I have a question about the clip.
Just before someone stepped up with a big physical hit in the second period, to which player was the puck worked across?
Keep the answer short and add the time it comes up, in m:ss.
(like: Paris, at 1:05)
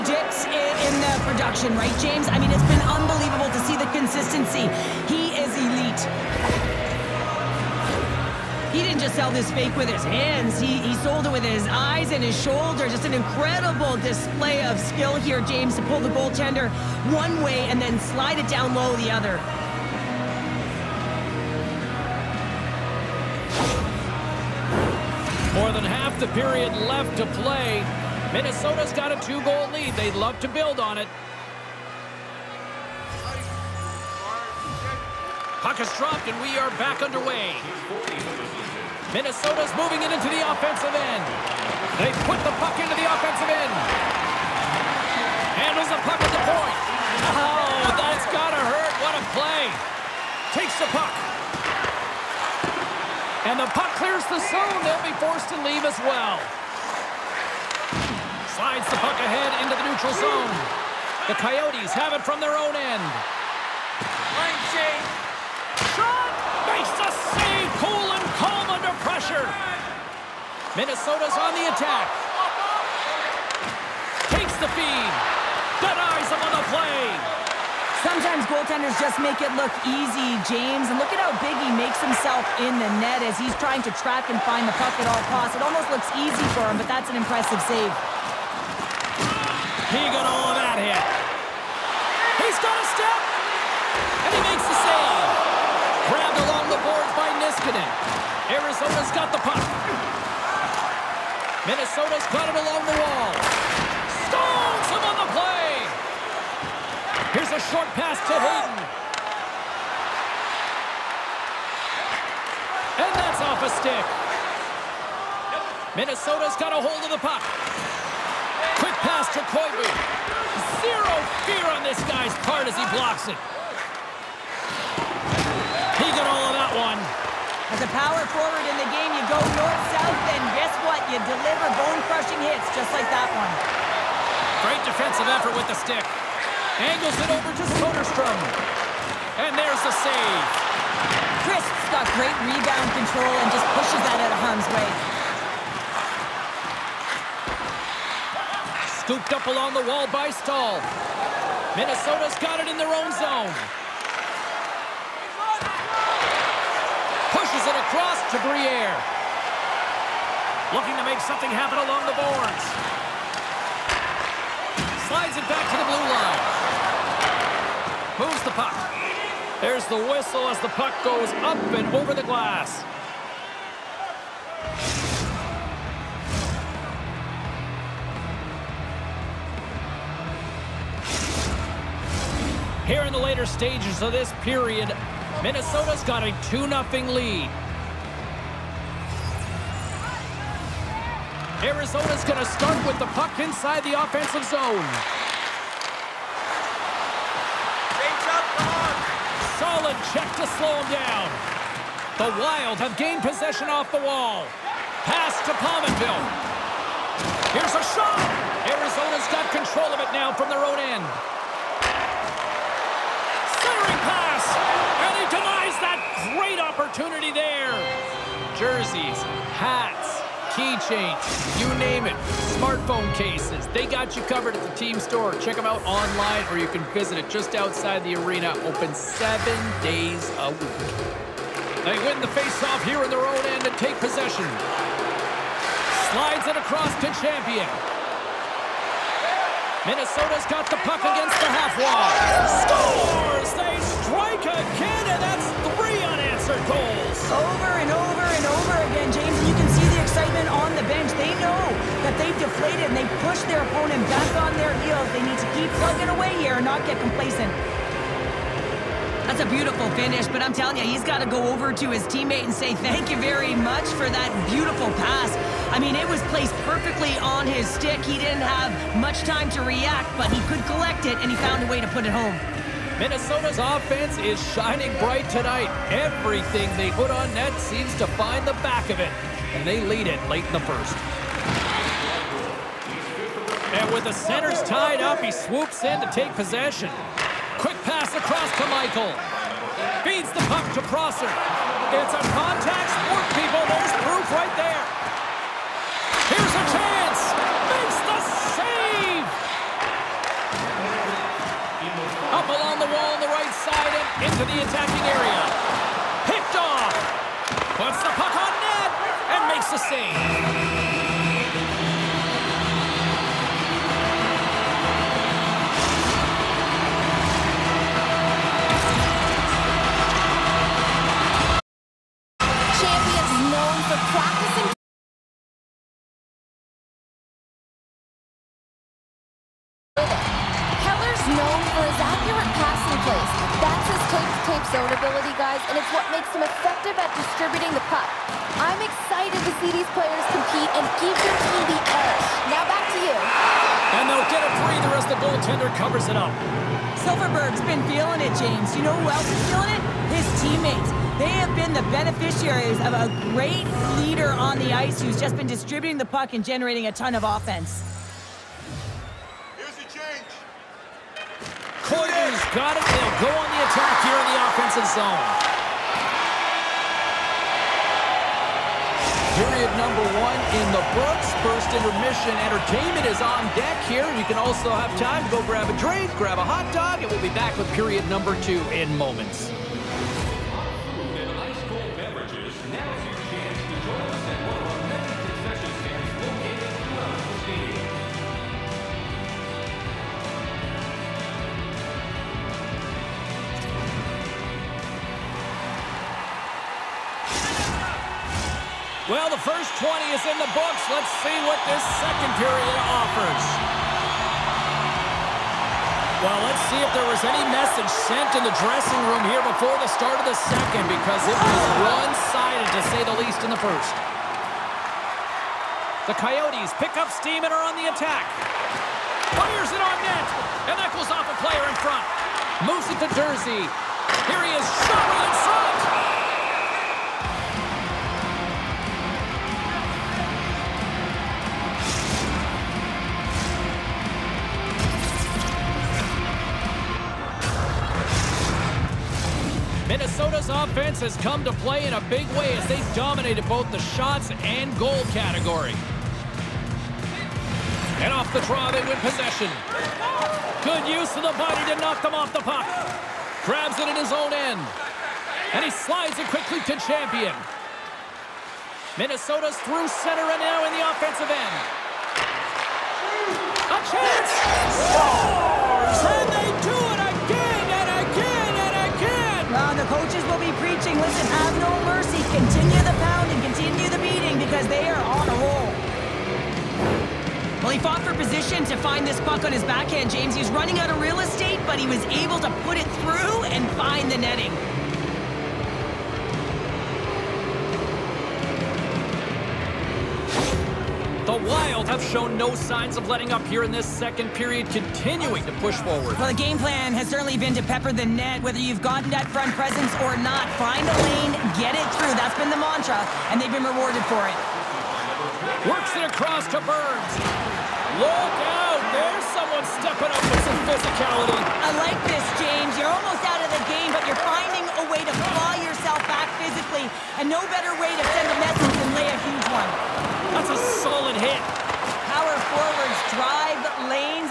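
Burns, at 8:26.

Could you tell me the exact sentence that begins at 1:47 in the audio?
Here's a short pass to Hayden.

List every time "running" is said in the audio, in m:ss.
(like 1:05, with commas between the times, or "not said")
8:00.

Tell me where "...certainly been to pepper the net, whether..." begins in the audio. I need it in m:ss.
8:17.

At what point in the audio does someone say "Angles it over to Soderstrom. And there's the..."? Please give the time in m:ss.
2:16.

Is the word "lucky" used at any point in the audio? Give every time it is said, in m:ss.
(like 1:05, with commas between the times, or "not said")
not said.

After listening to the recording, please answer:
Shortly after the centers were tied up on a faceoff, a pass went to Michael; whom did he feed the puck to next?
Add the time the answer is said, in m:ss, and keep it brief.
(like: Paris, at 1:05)
Prosser, at 4:50.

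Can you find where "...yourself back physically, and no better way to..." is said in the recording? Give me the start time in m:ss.
8:35.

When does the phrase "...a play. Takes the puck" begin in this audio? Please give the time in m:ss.
0:49.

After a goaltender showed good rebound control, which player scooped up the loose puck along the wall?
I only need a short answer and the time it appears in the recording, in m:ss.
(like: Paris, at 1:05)
Stahl, at 2:30.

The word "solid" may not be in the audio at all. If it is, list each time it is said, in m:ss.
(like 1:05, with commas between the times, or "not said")
3:19, 8:40.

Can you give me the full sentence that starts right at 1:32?
He's got a step, and he makes the save disconnect.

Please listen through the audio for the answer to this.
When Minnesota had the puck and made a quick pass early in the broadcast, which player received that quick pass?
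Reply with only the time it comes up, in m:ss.
1:59.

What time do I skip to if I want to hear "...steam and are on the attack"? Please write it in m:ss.
6:57.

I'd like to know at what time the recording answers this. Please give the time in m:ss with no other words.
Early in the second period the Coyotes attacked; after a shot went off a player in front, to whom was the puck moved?
7:03.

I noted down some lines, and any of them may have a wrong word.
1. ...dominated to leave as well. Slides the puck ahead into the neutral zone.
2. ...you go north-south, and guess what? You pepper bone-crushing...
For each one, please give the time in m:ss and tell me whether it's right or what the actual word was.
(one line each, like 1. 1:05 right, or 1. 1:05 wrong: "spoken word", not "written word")
1. 0:55 wrong: "forced", not "dominated"
2. 2:09 wrong: "deliver", not "pepper".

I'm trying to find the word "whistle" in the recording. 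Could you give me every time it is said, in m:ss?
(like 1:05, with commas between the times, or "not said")
2:49.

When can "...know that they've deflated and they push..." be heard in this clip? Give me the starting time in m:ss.
4:11.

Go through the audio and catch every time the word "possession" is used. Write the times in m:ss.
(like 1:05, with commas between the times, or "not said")
3:23, 3:53, 4:46, 7:29.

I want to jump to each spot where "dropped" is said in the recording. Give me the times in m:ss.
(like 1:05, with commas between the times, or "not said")
0:35.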